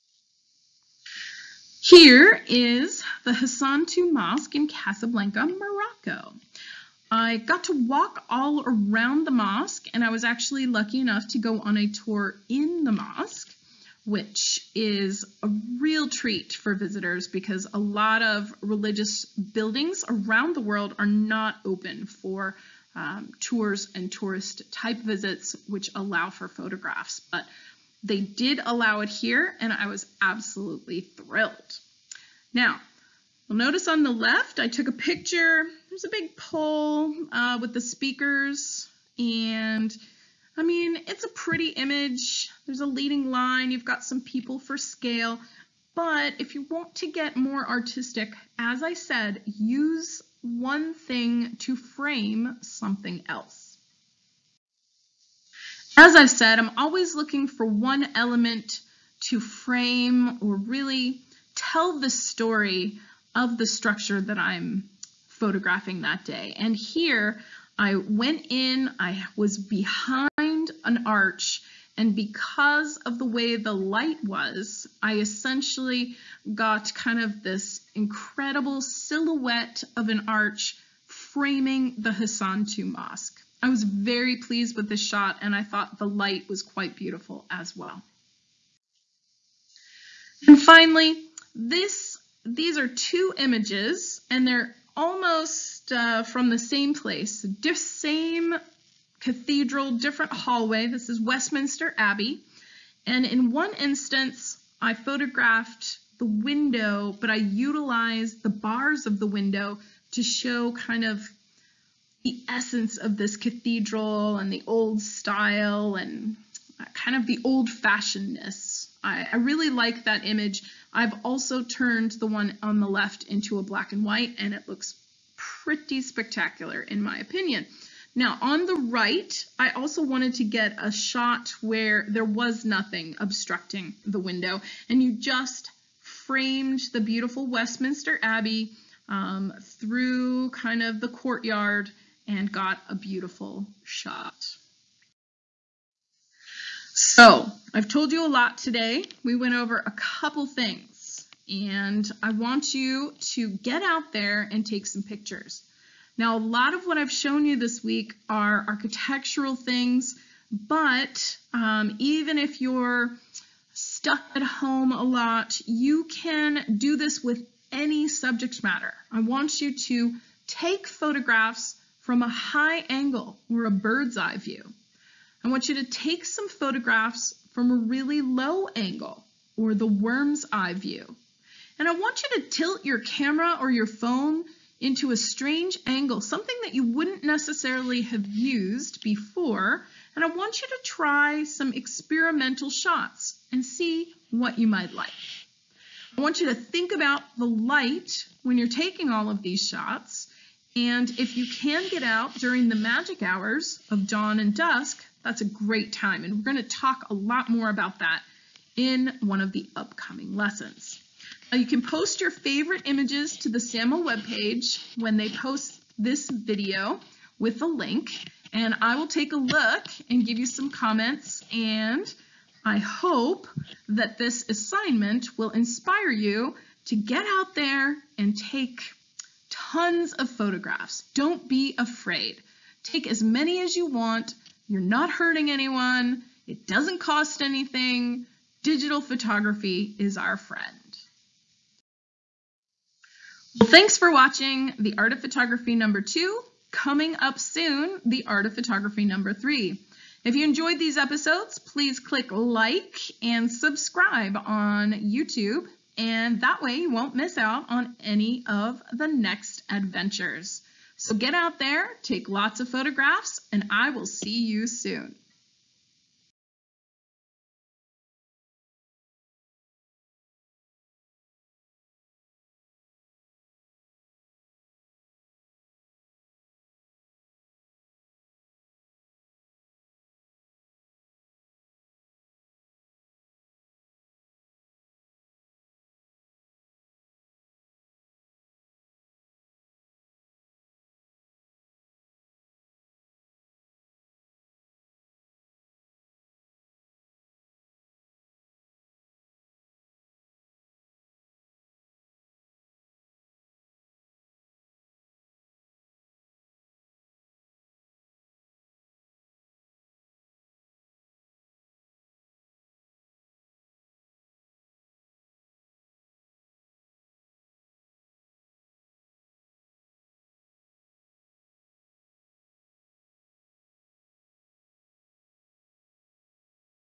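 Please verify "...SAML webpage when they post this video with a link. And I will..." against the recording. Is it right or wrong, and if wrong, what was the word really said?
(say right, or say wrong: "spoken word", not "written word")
right.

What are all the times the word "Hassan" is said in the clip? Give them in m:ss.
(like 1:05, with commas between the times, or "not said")
0:03, 1:22.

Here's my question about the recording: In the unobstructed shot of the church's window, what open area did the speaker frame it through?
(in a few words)
The courtyard.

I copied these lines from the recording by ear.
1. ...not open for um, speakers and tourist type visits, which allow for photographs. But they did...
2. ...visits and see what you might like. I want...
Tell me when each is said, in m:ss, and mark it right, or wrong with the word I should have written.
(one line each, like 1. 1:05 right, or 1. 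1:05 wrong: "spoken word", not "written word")
1. 0:21 wrong: "tours", not "speakers"
2. 3:12 wrong: "shots", not "visits".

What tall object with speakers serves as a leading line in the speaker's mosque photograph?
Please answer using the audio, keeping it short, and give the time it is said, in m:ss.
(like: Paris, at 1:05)
A big pole, at 0:36.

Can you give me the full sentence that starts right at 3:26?
And we're going to talk a lot more about that in one of the upcoming lessons.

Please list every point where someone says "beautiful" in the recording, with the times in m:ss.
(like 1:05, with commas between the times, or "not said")
1:26, 2:16, 2:22.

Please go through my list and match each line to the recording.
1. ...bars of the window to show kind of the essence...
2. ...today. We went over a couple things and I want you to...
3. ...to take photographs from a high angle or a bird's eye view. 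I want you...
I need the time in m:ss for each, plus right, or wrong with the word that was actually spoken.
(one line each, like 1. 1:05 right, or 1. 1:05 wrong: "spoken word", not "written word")
1. 1:48 right
2. 2:28 right
3. 2:49 right.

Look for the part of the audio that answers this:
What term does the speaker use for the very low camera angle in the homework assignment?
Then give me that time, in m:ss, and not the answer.
2:59.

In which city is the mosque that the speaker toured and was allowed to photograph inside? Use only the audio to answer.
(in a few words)
Casablanca.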